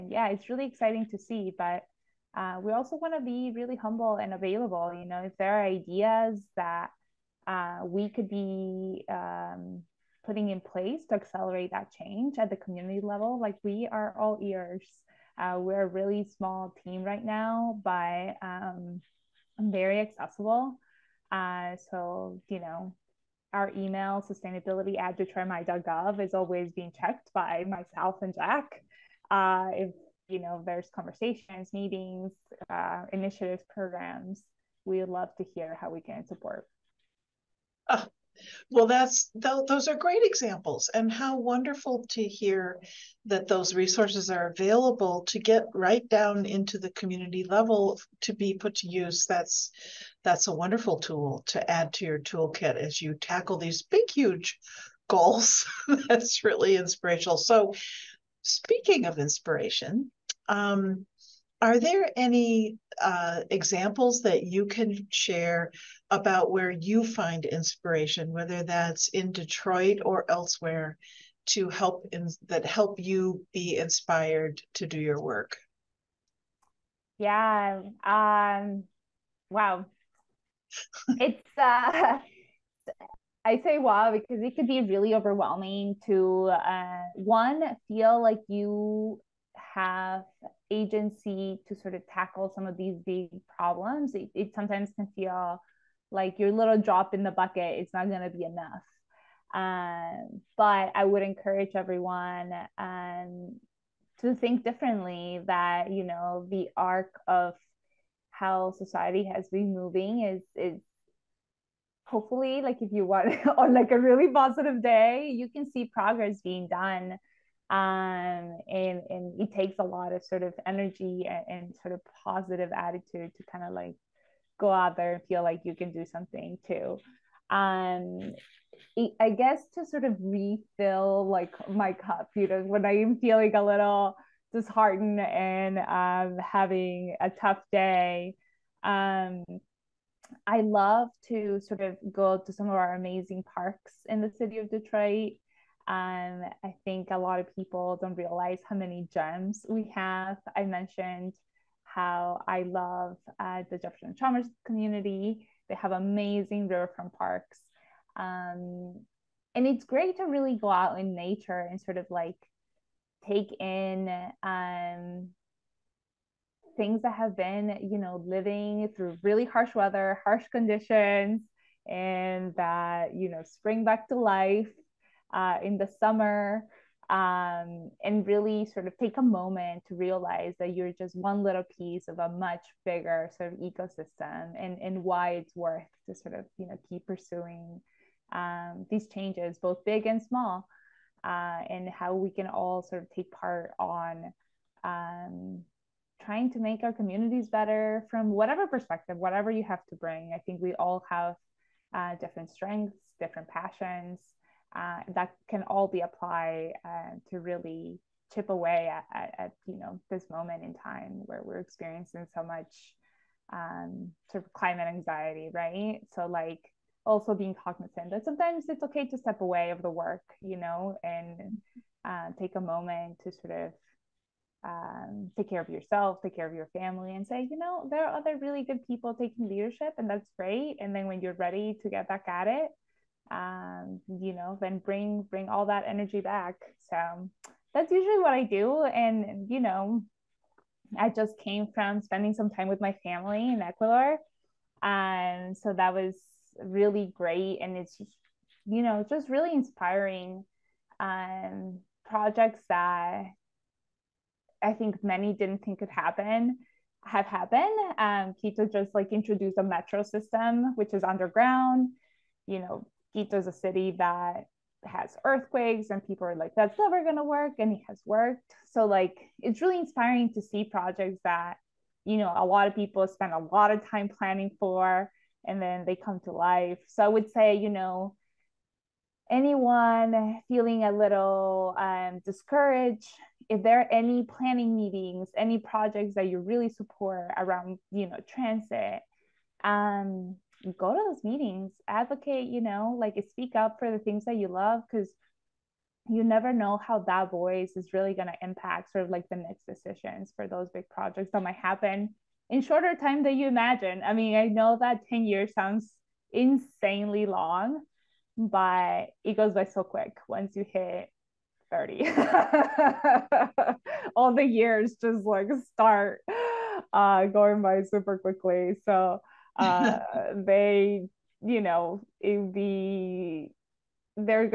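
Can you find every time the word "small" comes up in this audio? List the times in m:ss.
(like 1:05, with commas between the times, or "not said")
0:16, 3:10.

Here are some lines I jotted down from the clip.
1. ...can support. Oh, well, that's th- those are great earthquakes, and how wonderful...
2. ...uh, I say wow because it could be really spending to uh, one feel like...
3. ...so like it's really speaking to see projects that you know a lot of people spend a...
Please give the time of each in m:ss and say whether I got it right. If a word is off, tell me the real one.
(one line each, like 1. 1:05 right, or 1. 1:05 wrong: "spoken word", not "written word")
1. 0:36 wrong: "examples", not "earthquakes"
2. 1:21 wrong: "overwhelming", not "spending"
3. 4:28 wrong: "inspiring", not "speaking".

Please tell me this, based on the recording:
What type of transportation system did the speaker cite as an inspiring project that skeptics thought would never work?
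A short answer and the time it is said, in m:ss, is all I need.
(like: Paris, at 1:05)
metro system, at 4:19.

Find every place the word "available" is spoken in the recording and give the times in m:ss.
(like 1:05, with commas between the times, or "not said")
0:04, 0:44.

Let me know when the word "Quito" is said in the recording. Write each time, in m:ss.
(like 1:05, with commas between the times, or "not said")
4:18, 4:23.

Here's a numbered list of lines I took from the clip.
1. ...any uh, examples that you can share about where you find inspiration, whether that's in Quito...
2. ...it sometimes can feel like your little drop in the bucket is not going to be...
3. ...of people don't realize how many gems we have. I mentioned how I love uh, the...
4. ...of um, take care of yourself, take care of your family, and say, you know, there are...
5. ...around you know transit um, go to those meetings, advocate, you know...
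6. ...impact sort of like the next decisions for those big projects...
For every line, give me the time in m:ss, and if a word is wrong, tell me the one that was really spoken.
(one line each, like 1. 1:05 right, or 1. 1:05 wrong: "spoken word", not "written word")
1. 1:02 wrong: "Detroit", not "Quito"
2. 1:34 right
3. 2:27 right
4. 3:43 right
5. 4:47 right
6. 4:58 right.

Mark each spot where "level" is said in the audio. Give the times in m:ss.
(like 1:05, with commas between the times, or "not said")
0:13, 0:47.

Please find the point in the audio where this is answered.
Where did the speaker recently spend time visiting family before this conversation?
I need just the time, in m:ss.
4:03.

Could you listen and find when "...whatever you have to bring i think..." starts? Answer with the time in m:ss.
3:19.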